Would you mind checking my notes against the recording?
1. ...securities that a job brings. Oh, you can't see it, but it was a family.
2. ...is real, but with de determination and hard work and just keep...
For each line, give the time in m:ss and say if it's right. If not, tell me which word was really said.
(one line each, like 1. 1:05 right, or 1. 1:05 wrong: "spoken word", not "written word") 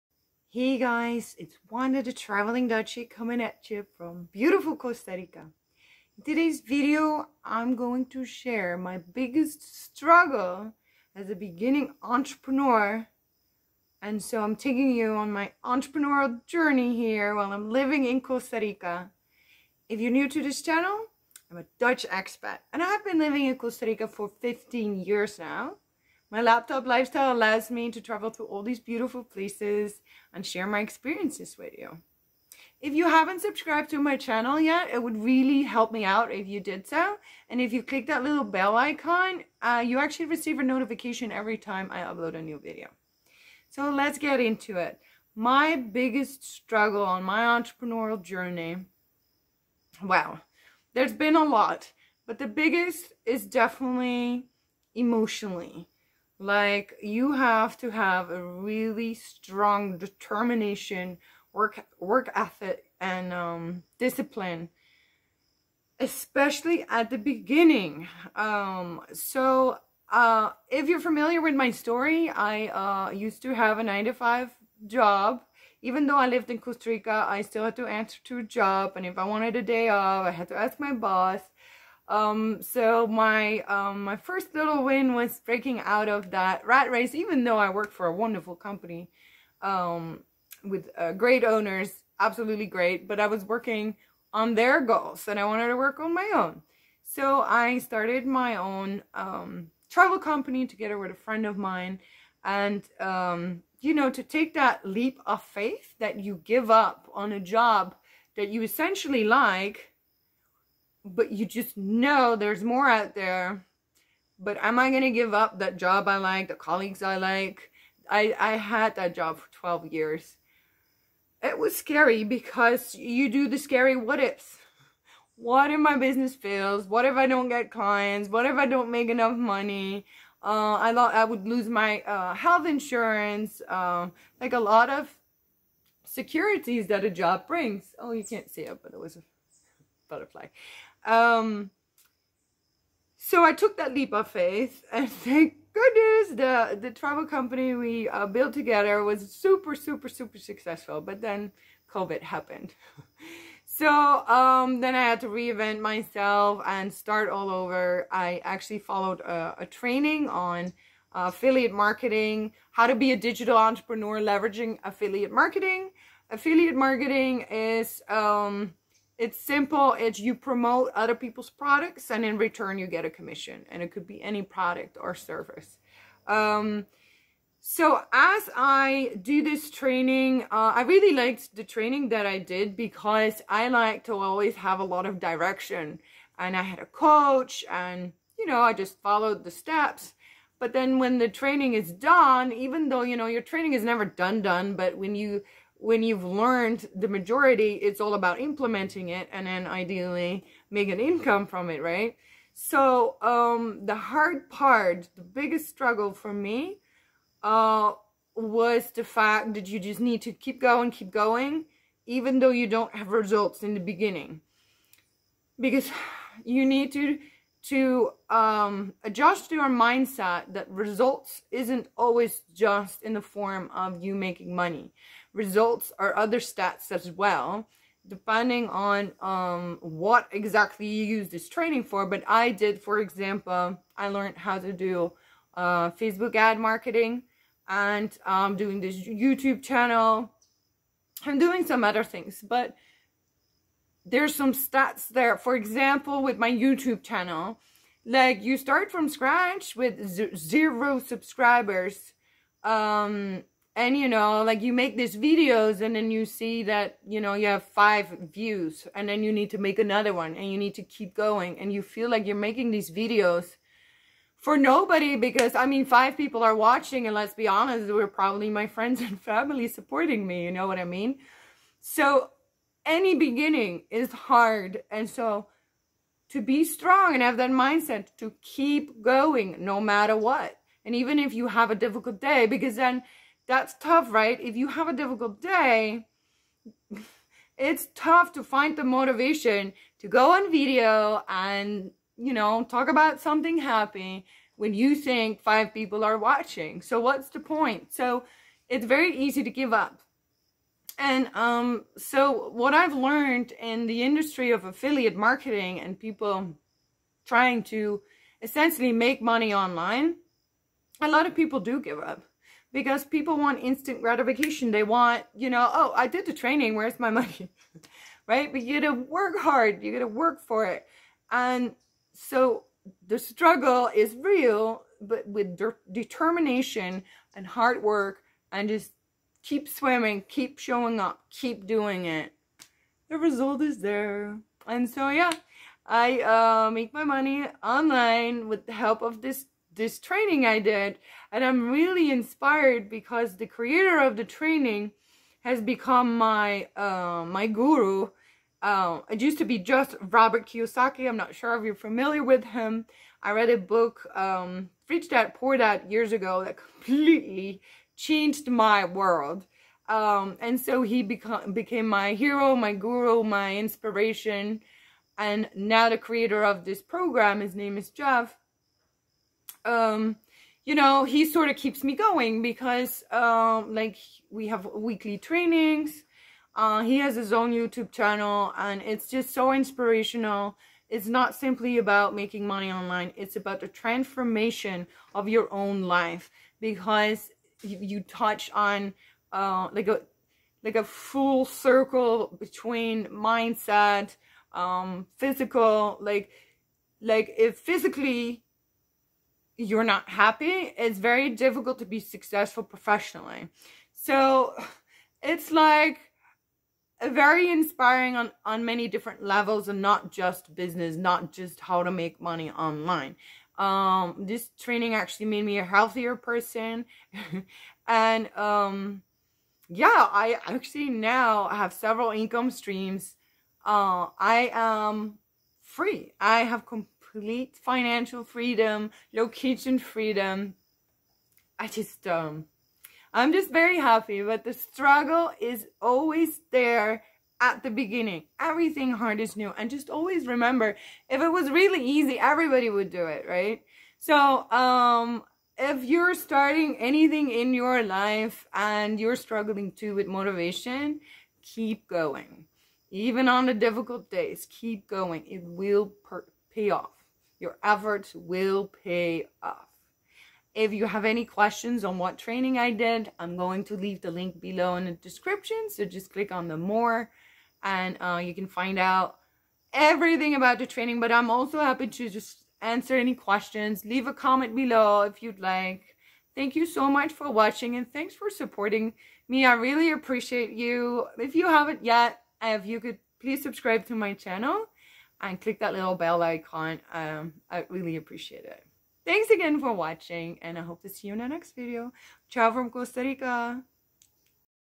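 1. 2:16 wrong: "butterfly", not "family"
2. 5:23 right.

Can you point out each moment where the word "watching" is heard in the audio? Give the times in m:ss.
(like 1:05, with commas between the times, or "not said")
4:26, 4:56, 7:57, 8:09.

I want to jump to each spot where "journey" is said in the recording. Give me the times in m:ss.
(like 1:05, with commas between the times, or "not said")
0:16, 0:48.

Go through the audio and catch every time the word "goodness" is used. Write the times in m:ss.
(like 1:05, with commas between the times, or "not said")
2:25.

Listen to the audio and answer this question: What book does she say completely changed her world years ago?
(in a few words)
Rich Dad Poor Dad.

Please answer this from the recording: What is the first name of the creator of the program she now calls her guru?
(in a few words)
Jeff.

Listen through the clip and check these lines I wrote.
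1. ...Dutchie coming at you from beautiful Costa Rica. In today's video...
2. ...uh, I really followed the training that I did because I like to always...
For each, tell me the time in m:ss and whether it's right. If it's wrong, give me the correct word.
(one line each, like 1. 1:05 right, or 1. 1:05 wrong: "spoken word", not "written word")
1. 0:02 right
2. 3:00 wrong: "liked", not "followed".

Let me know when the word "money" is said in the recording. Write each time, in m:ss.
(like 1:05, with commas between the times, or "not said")
2:09, 3:44, 5:09, 5:17, 5:37, 6:22, 6:52.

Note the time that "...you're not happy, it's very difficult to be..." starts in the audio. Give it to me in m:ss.
6:39.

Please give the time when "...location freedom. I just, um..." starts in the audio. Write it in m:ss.
7:09.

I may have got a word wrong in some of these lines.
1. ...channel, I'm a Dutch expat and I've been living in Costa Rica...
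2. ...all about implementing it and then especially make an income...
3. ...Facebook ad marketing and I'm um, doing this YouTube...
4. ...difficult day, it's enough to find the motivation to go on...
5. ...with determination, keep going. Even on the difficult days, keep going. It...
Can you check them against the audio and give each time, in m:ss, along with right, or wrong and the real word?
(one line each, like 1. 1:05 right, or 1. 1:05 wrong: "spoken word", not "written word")
1. 0:20 right
2. 3:17 wrong: "ideally", not "especially"
3. 3:55 right
4. 4:44 wrong: "tough", not "enough"
5. 7:29 wrong: "motivation", not "determination".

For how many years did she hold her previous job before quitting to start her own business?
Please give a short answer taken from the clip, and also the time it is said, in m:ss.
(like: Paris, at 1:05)
12, at 1:59.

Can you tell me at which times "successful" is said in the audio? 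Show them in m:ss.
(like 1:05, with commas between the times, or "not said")
2:30, 6:41.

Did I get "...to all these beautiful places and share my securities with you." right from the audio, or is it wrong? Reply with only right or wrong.
wrong.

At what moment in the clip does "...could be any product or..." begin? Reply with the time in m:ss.
2:53.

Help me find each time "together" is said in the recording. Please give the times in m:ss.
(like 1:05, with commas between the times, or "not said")
1:40, 2:28.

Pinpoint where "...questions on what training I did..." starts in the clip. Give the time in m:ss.
7:41.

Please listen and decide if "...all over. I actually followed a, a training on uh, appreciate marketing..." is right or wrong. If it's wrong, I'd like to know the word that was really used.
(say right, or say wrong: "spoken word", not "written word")
wrong: "affiliate", not "appreciate".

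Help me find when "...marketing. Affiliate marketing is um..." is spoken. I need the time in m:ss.
2:45.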